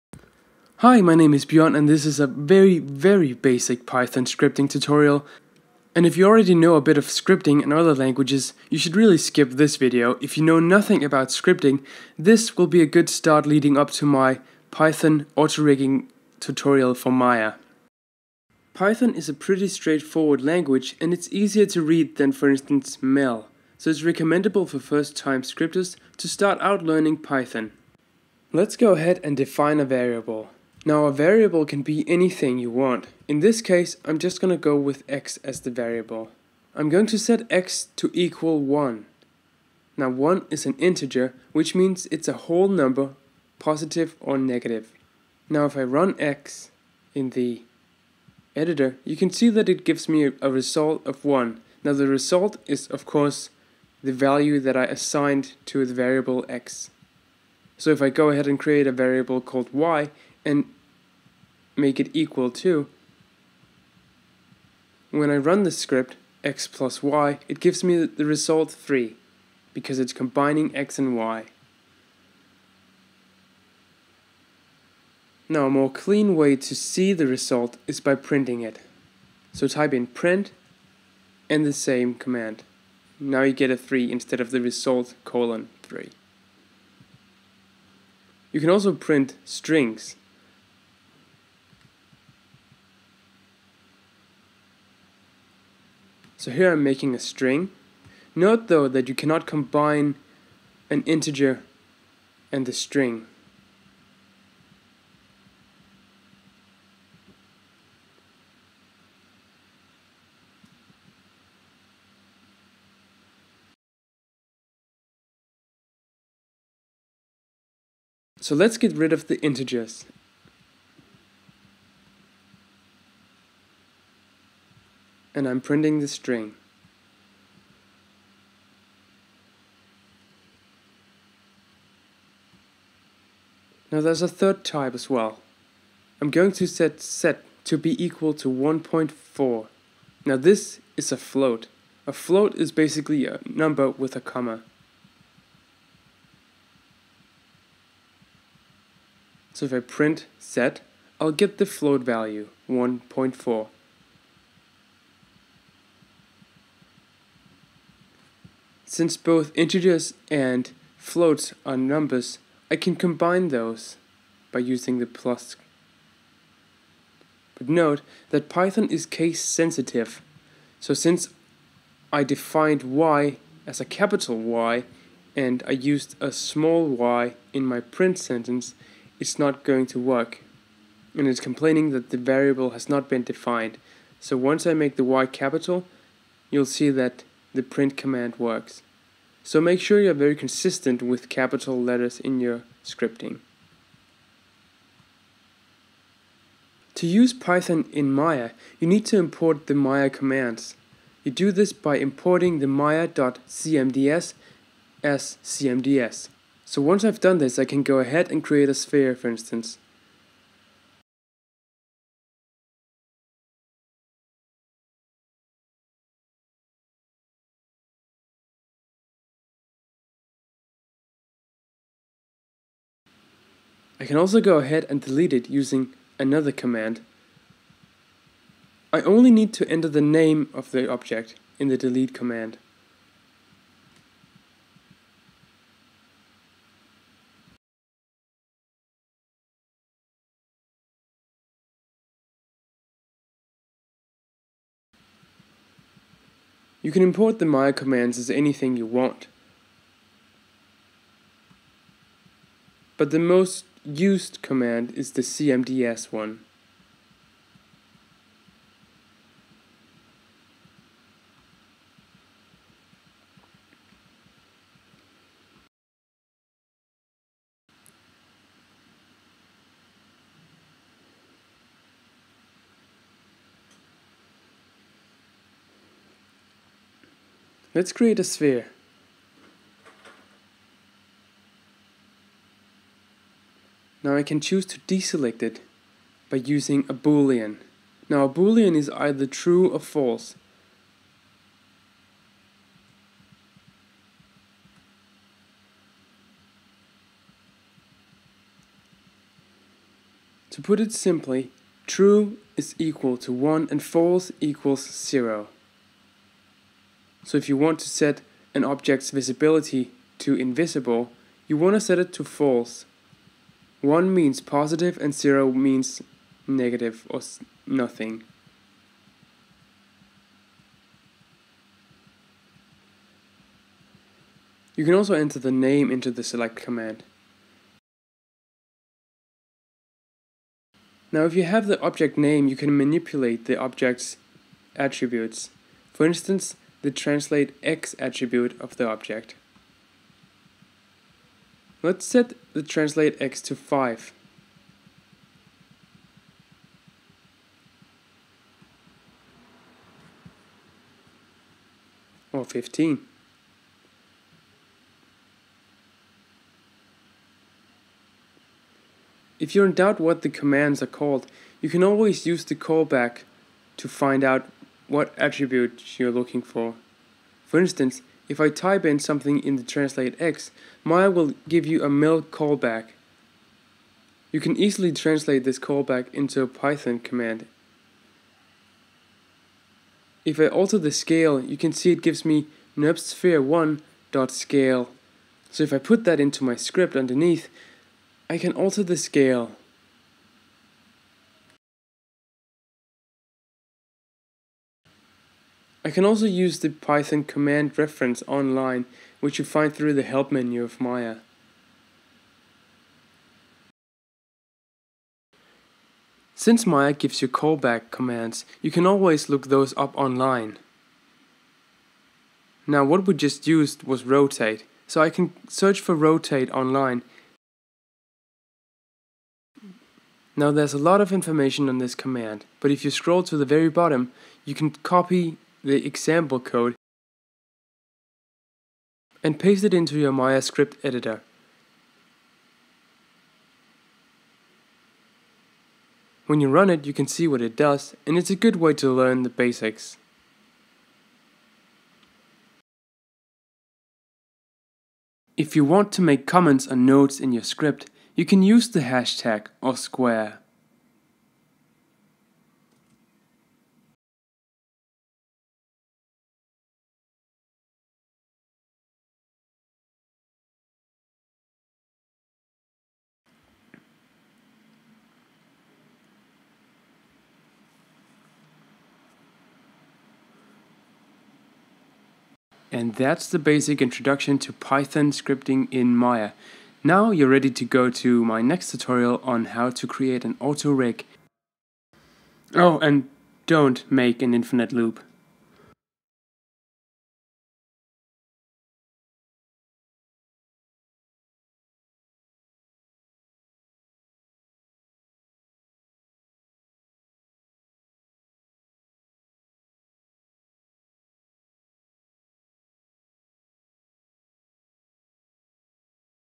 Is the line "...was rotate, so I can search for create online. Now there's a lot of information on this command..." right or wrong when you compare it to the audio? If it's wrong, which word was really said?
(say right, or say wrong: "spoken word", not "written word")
wrong: "rotate", not "create".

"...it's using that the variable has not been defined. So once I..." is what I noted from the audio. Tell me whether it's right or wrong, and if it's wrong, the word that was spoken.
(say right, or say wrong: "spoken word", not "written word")
wrong: "complaining", not "using".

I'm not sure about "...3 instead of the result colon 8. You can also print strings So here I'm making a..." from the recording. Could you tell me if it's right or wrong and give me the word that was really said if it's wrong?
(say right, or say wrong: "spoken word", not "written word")
wrong: "3", not "8".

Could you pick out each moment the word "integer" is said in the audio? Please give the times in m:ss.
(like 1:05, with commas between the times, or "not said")
0:40, 1:41, 1:59, 2:39.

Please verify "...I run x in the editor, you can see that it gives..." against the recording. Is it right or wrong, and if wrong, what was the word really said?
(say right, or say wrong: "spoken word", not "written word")
right.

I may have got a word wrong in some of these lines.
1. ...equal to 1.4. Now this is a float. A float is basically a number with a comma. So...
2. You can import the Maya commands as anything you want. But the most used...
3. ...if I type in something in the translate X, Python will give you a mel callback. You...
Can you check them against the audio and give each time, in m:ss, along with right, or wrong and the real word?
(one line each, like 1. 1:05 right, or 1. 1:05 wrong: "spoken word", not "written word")
1. 2:18 right
2. 4:06 right
3. 6:08 wrong: "Maya", not "Python".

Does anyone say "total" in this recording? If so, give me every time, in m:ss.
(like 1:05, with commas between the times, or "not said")
not said.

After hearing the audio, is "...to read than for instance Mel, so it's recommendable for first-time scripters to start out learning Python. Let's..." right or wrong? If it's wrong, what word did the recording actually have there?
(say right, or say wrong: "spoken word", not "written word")
right.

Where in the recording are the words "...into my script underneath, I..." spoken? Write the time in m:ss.
6:26.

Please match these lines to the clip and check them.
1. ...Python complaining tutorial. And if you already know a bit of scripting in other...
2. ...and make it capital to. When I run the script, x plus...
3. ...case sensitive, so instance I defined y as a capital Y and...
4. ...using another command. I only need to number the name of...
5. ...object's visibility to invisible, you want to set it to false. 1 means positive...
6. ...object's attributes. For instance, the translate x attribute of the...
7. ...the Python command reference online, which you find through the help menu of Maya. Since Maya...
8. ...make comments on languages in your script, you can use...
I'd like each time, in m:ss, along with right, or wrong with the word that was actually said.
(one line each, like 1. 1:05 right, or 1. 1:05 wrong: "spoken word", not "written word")
1. 0:03 wrong: "scripting", not "complaining"
2. 1:00 wrong: "equal", not "capital"
3. 2:49 wrong: "since", not "instance"
4. 3:45 wrong: "enter", not "number"
5. 5:08 right
6. 5:33 right
7. 6:36 right
8. 7:26 wrong: "nodes", not "languages".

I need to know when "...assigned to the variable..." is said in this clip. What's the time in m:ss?
0:54.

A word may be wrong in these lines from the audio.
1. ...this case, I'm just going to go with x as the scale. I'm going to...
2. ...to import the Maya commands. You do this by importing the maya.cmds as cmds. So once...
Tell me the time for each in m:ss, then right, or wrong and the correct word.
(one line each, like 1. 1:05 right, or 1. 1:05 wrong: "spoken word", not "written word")
1. 0:33 wrong: "variable", not "scale"
2. 3:19 right.